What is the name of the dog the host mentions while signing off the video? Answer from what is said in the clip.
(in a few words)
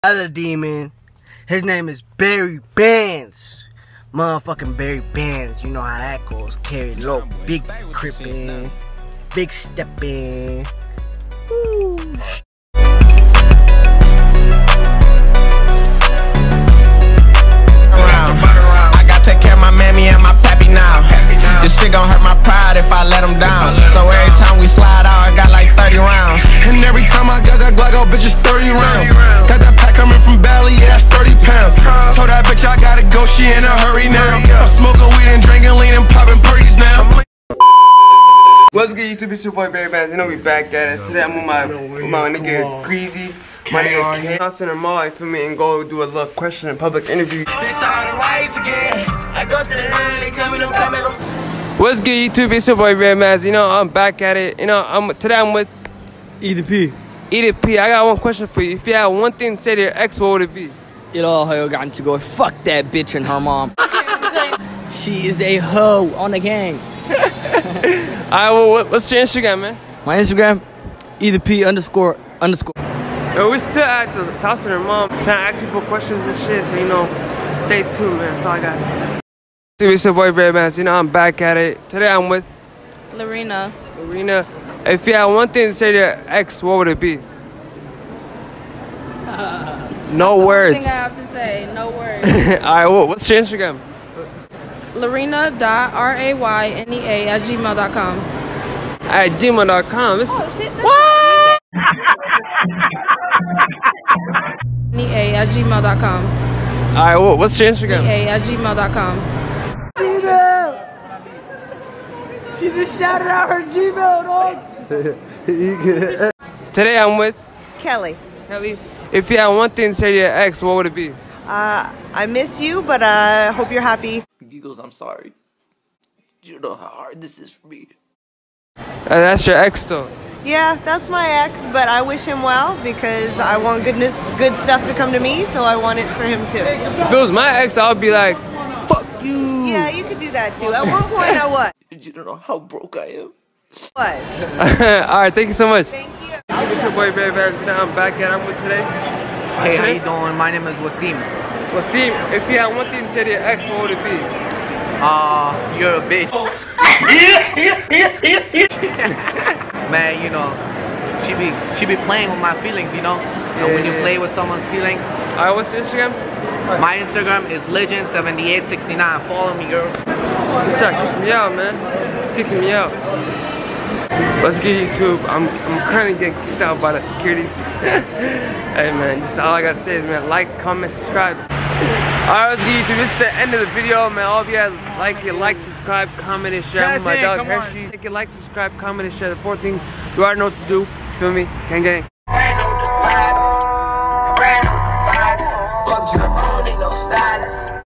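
Hershey.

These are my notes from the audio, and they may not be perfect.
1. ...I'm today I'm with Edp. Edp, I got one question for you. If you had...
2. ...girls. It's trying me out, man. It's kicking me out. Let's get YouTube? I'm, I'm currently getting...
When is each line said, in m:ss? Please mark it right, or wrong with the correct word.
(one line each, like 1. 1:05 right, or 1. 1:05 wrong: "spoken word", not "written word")
1. 0:54 right
2. 2:49 wrong: "kicking", not "trying".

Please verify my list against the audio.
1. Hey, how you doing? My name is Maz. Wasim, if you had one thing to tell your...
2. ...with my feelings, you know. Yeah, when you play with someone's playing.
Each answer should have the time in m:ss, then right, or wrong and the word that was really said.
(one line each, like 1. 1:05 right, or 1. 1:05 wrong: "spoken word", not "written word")
1. 2:29 wrong: "Wasim", not "Maz"
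2. 2:42 wrong: "feeling", not "playing".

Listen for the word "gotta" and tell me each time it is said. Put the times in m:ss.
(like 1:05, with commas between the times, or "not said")
1:18, 2:59.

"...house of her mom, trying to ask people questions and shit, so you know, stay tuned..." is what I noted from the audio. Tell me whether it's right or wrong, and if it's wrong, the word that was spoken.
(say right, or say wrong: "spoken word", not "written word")
right.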